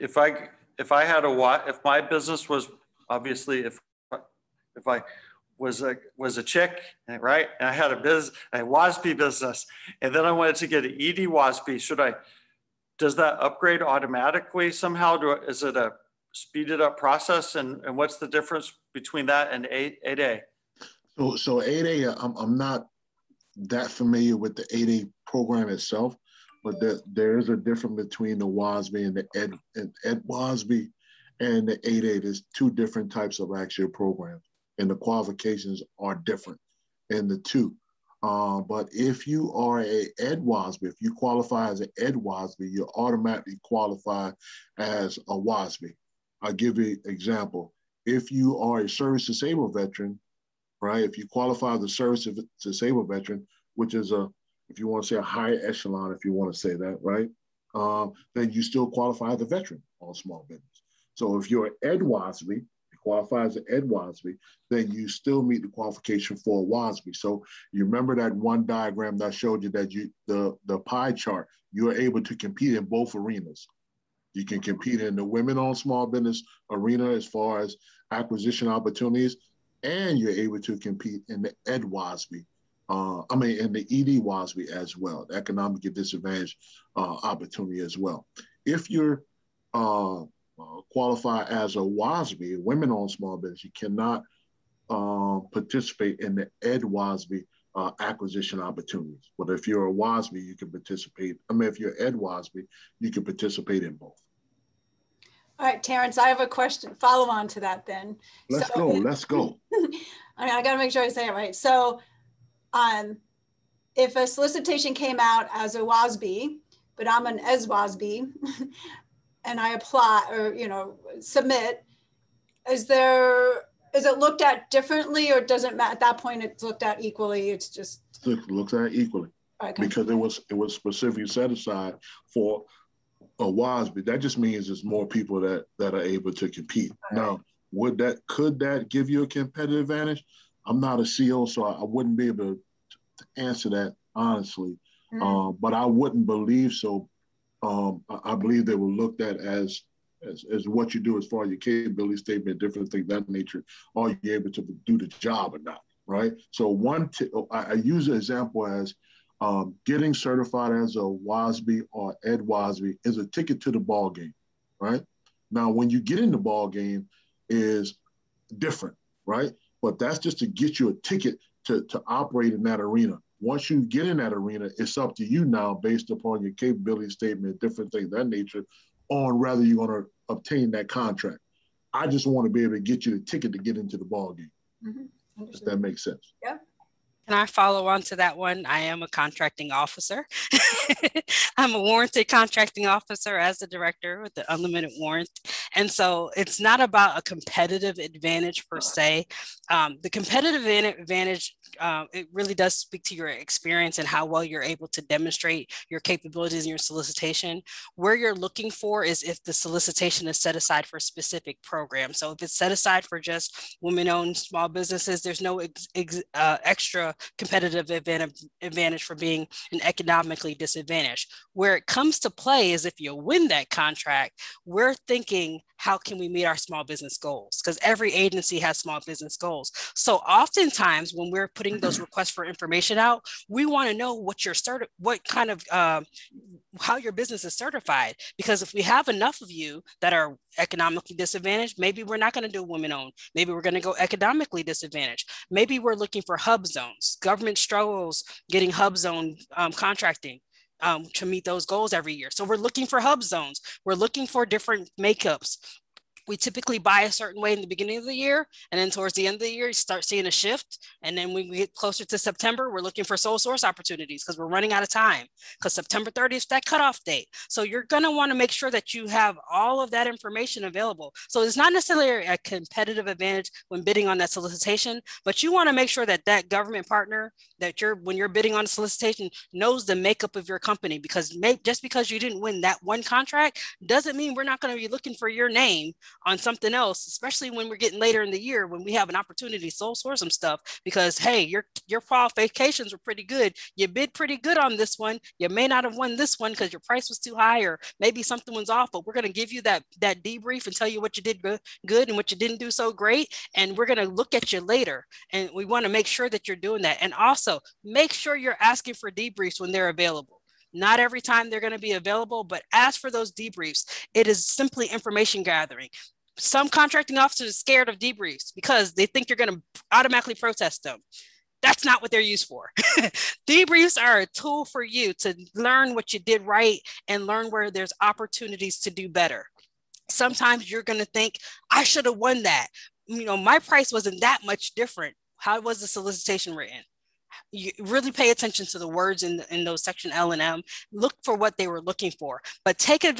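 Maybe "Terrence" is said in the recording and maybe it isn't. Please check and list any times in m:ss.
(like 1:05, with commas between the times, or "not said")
1:45.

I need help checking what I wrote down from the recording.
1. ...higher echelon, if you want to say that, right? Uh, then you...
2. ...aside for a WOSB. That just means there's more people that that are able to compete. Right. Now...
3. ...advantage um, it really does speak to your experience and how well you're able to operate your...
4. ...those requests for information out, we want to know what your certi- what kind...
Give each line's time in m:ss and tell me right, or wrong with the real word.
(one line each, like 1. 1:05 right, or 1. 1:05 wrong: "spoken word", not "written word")
1. 0:55 right
2. 2:11 right
3. 3:20 wrong: "demonstrate", not "operate"
4. 3:51 right.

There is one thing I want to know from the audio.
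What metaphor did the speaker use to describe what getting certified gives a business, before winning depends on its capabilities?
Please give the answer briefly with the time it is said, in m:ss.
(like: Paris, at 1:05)
ticket to the ball game, at 2:43.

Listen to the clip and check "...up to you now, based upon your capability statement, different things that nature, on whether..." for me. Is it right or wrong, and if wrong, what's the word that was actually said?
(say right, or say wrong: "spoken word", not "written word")
right.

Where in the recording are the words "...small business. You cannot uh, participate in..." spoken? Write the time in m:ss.
1:33.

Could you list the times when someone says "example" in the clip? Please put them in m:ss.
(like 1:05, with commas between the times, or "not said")
0:47, 2:38.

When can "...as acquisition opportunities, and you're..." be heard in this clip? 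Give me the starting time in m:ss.
1:17.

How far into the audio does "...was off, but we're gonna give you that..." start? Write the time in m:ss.
4:58.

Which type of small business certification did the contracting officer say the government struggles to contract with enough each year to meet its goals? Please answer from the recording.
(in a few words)
HUBZone.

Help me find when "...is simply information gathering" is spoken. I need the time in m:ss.
5:14.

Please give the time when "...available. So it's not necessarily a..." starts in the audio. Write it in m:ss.
4:30.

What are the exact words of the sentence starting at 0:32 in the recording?
There's two different types of actual programs and the qualifications are different in the two.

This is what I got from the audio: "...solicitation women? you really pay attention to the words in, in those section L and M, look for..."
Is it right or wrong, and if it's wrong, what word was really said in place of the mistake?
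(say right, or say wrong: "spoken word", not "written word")
wrong: "written", not "women".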